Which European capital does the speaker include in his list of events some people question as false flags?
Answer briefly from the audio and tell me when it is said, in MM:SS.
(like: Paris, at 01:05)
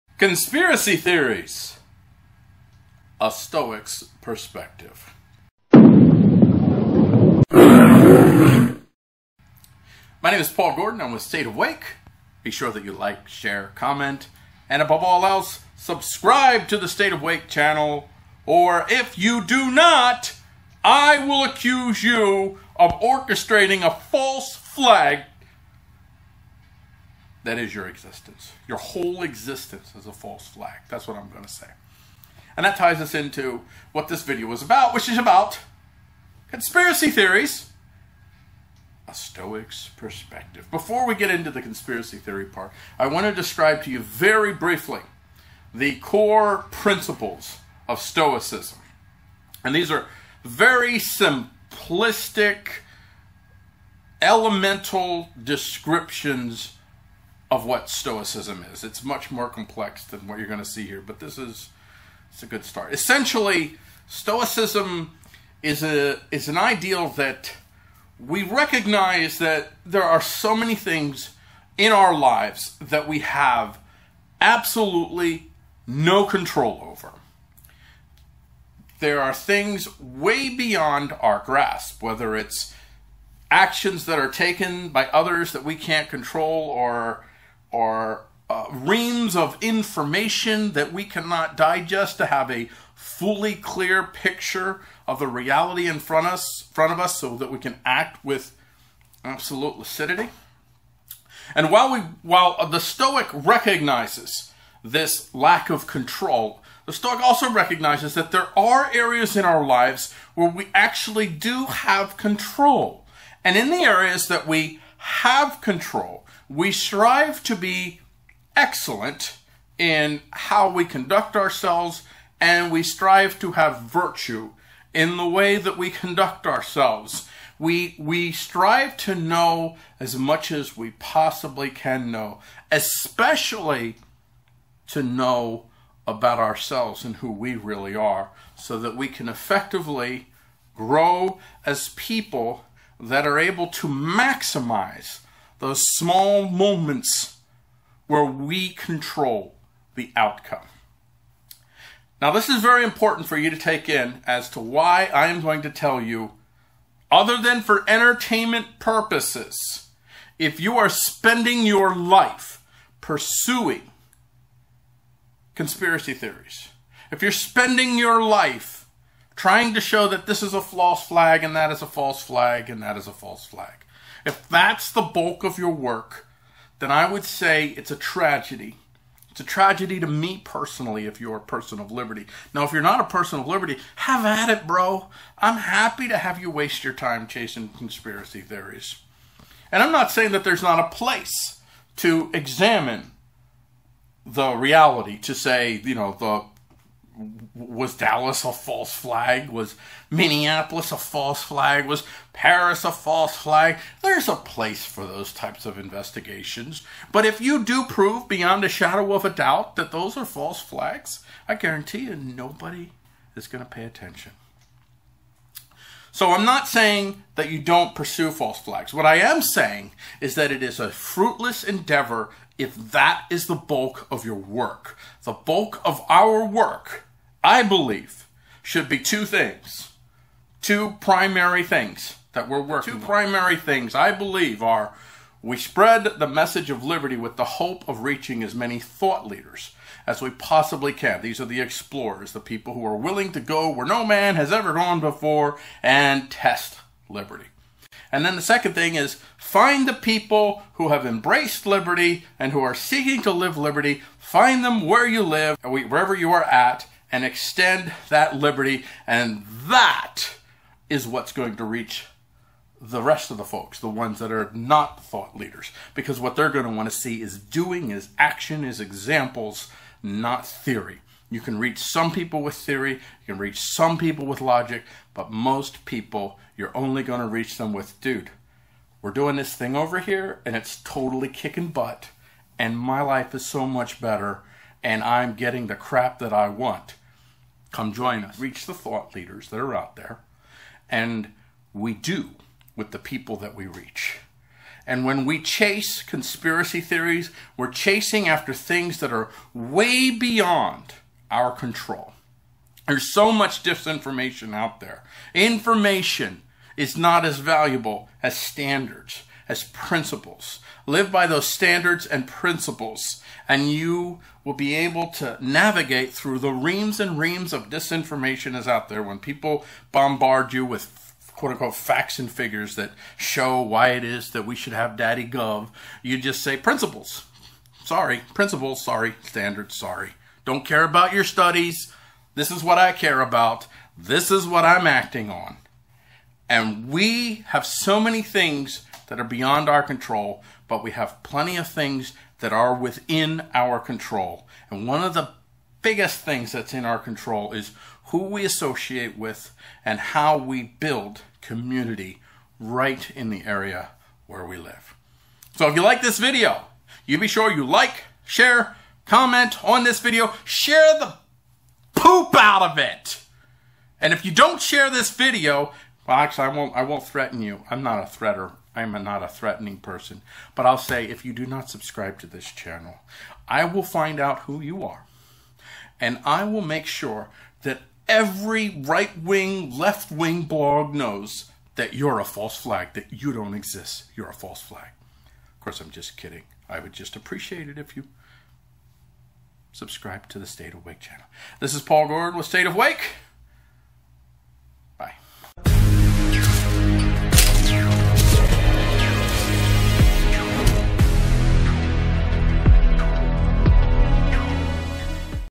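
Paris, at 03:22.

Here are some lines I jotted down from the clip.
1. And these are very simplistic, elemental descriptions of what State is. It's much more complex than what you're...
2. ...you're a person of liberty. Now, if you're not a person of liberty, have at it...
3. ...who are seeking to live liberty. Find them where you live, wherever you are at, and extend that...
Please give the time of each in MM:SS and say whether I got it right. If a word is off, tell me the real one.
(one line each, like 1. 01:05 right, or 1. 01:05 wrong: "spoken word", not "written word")
1. 00:49 wrong: "Stoicism", not "State"
2. 03:01 right
3. 04:12 right.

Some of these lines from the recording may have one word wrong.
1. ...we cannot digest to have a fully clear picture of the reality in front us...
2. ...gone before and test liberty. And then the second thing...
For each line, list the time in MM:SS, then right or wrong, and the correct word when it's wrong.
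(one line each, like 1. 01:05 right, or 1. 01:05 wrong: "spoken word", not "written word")
1. 01:30 right
2. 04:04 right.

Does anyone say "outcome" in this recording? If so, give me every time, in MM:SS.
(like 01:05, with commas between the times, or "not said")
02:30.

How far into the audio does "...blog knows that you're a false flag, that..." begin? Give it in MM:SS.
06:20.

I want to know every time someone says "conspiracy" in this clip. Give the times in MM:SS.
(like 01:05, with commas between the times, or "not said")
00:00, 00:36, 00:41, 02:45, 03:07, 04:56.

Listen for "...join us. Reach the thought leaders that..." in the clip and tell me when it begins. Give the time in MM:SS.
04:47.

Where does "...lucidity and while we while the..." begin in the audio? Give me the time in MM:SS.
01:39.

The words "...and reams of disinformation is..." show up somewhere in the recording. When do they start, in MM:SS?
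05:16.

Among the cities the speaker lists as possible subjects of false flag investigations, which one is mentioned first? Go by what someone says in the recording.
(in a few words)
Dallas.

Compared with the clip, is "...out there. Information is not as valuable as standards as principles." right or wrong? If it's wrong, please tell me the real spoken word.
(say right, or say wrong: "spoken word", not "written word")
right.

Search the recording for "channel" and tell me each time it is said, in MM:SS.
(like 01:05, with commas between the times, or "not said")
00:17, 06:12, 06:31.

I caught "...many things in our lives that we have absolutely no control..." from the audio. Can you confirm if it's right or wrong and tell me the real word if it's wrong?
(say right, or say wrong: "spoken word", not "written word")
right.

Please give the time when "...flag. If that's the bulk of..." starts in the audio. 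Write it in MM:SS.
02:53.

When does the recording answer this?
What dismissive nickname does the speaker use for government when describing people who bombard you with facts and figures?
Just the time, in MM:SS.
05:24.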